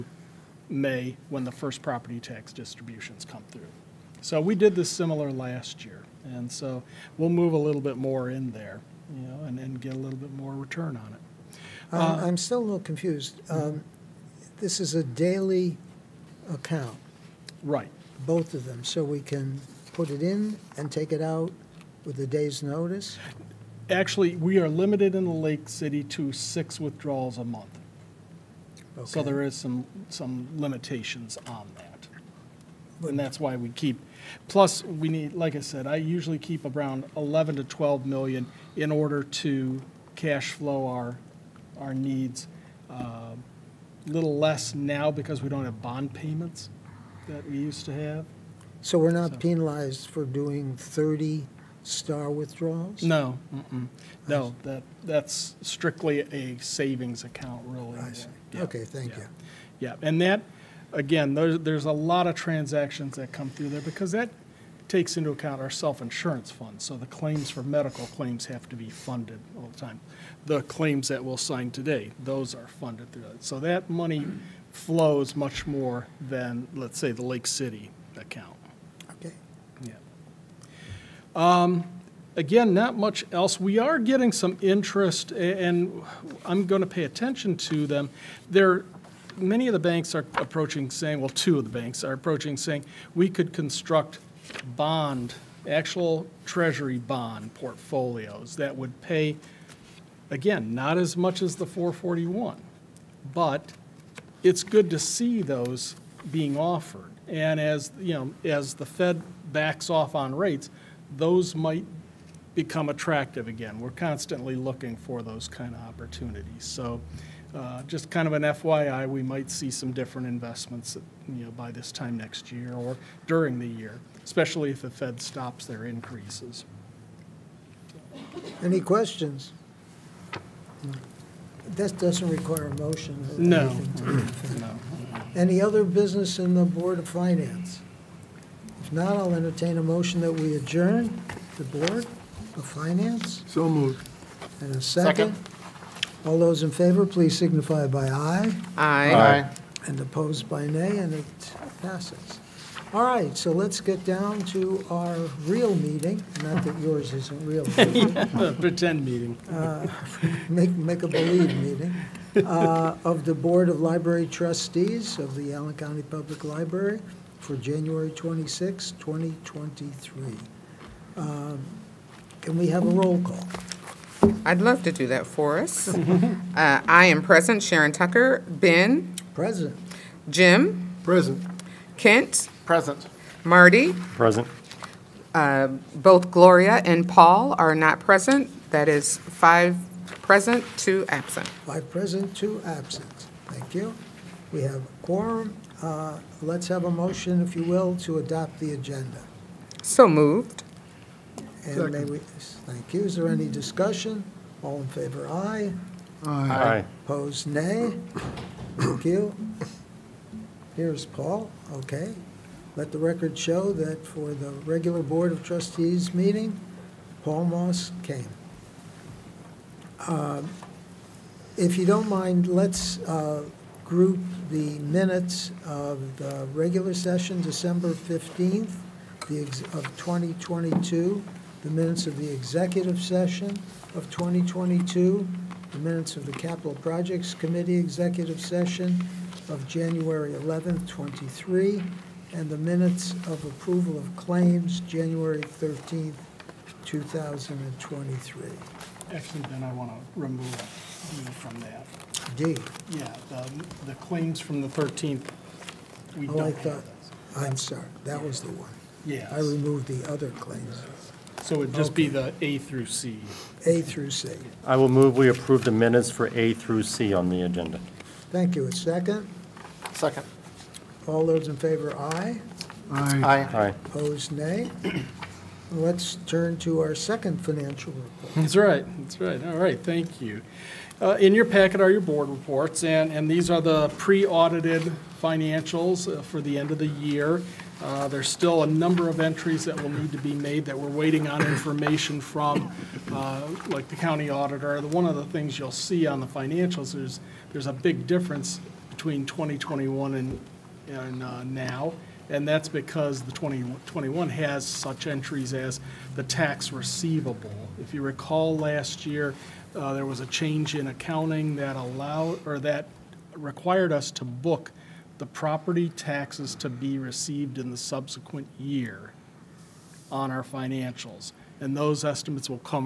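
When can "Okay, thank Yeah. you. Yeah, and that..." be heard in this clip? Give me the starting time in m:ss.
0:58.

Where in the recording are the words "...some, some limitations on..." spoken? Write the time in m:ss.
0:29.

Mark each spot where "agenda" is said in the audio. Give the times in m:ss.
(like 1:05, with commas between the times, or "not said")
3:18, 4:27.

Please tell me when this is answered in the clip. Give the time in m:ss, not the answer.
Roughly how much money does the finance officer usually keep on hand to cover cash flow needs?
0:37.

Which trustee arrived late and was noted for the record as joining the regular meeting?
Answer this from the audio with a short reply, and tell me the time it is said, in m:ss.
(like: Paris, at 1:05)
Paul Moss, at 3:37.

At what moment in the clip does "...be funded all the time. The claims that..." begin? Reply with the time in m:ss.
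1:08.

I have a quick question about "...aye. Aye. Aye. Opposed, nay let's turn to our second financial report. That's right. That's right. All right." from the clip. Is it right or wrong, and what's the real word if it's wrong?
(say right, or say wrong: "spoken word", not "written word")
right.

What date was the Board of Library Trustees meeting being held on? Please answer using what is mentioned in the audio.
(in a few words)
January 26, 2023.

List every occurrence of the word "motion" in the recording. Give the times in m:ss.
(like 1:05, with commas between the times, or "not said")
2:12, 2:19, 3:16.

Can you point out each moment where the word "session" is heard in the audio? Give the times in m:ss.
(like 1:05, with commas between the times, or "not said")
3:46, 3:53, 3:58.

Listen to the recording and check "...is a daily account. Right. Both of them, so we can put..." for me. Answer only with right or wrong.
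right.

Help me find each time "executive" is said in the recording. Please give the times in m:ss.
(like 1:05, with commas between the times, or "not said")
3:52, 3:57.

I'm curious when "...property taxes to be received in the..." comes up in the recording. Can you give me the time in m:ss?
5:15.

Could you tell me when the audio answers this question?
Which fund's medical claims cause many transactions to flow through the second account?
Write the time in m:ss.
1:05.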